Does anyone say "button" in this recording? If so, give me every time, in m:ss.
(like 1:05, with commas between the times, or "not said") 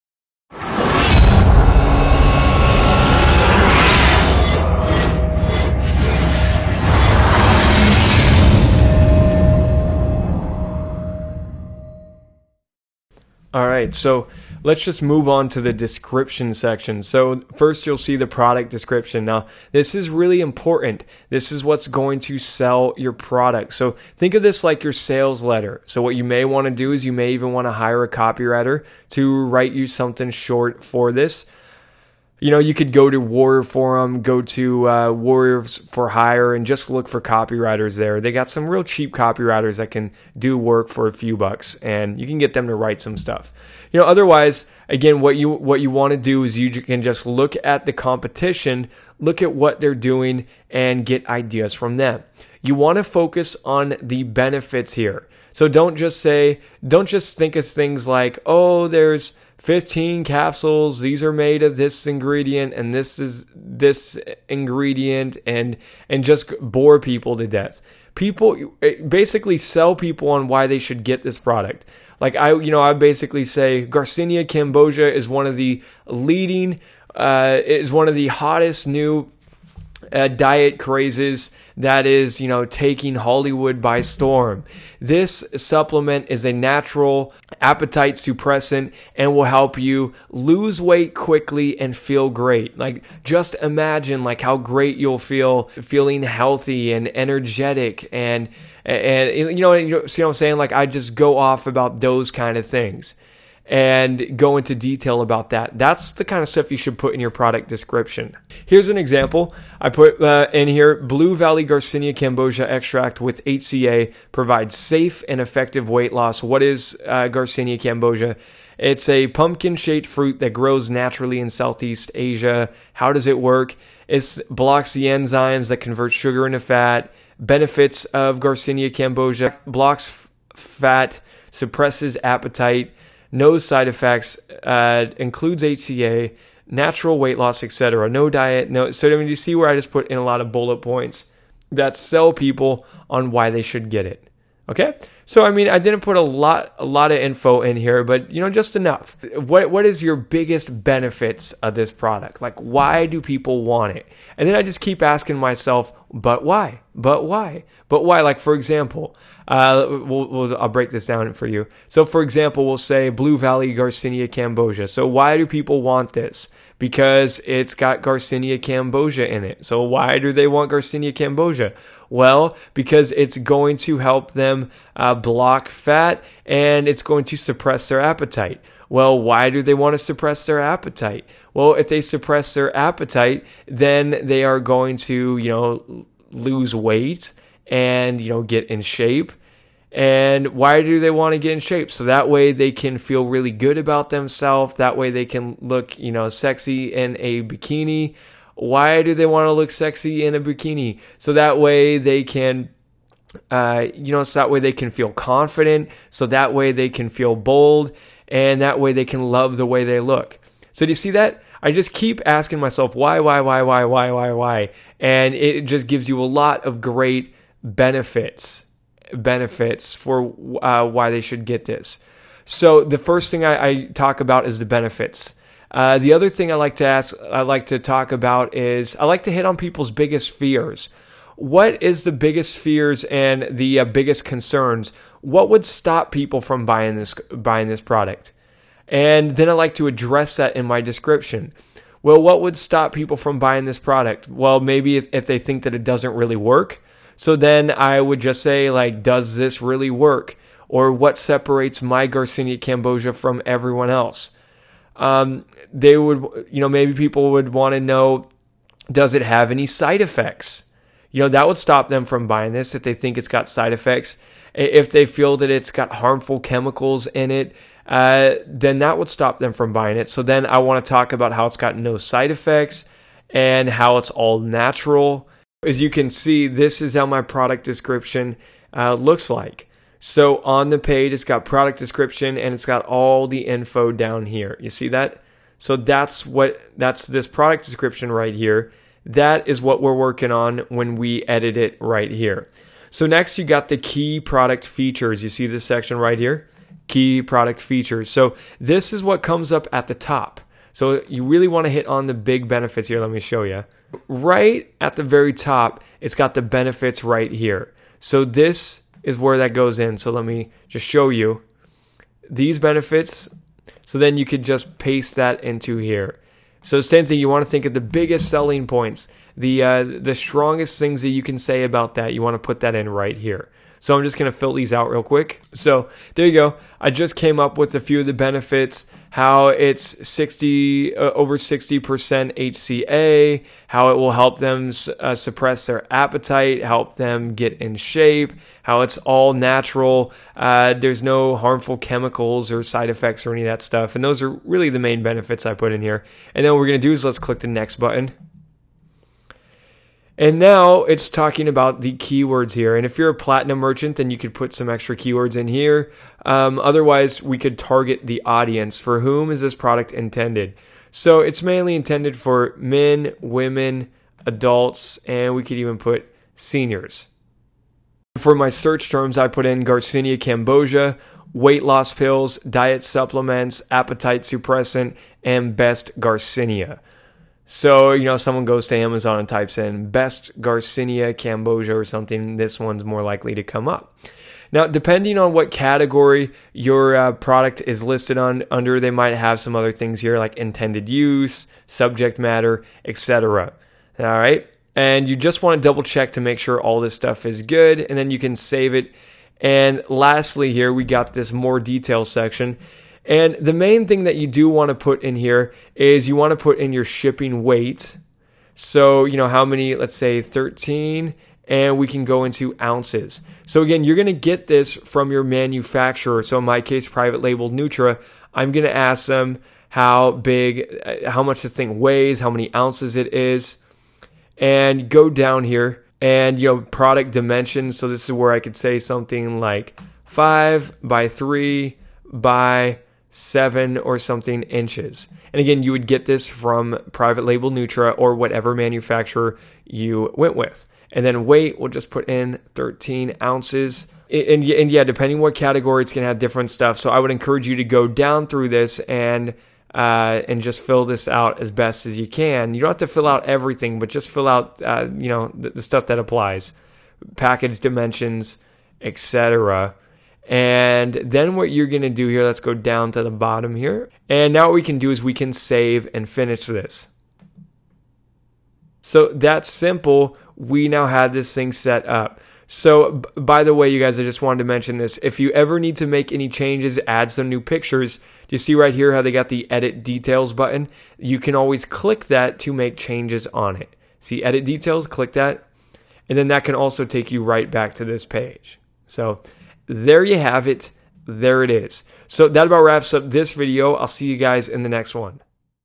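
5:47, 8:00.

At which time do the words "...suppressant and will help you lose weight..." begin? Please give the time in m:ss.
1:28.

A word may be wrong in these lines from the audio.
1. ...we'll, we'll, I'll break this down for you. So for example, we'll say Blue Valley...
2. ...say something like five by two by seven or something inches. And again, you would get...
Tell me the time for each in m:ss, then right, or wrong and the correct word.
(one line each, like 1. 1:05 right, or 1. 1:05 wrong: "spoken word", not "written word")
1. 2:39 right
2. 7:08 wrong: "three", not "two".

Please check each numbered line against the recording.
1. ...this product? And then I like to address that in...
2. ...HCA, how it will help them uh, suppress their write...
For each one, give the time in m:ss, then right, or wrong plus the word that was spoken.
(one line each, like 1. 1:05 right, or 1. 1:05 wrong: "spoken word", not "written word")
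1. 3:57 right
2. 5:31 wrong: "appetite", not "write".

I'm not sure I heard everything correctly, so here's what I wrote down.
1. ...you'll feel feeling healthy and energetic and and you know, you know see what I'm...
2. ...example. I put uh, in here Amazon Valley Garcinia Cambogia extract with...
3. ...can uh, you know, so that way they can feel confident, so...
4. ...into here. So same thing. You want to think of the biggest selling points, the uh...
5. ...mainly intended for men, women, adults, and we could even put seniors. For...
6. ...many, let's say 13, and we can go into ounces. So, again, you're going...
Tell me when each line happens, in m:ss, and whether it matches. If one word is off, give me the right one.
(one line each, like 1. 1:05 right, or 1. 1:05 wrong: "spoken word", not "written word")
1. 1:34 right
2. 1:48 wrong: "Blue", not "Amazon"
3. 3:22 right
4. 5:15 right
5. 6:01 right
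6. 6:49 right.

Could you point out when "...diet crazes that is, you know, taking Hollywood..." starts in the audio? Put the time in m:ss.
1:20.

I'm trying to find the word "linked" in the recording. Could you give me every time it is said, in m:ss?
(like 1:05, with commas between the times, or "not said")
not said.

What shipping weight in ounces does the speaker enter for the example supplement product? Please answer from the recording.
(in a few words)
13 ounces.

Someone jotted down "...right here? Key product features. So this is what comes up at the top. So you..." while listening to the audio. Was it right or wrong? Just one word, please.
right.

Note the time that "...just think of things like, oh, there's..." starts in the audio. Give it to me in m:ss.
0:57.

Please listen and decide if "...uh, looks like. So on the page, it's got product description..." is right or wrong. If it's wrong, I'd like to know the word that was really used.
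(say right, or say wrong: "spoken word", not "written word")
right.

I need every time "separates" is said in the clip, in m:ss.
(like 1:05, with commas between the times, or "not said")
4:11.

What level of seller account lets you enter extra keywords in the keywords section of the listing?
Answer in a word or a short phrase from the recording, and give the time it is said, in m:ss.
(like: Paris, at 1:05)
platinum merchant, at 5:53.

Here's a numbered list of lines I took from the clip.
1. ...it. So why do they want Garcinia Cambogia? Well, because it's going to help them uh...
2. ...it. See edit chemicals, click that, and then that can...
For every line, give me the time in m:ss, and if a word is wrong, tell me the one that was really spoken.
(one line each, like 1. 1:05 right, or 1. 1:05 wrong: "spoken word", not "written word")
1. 2:49 right
2. 8:03 wrong: "details", not "chemicals".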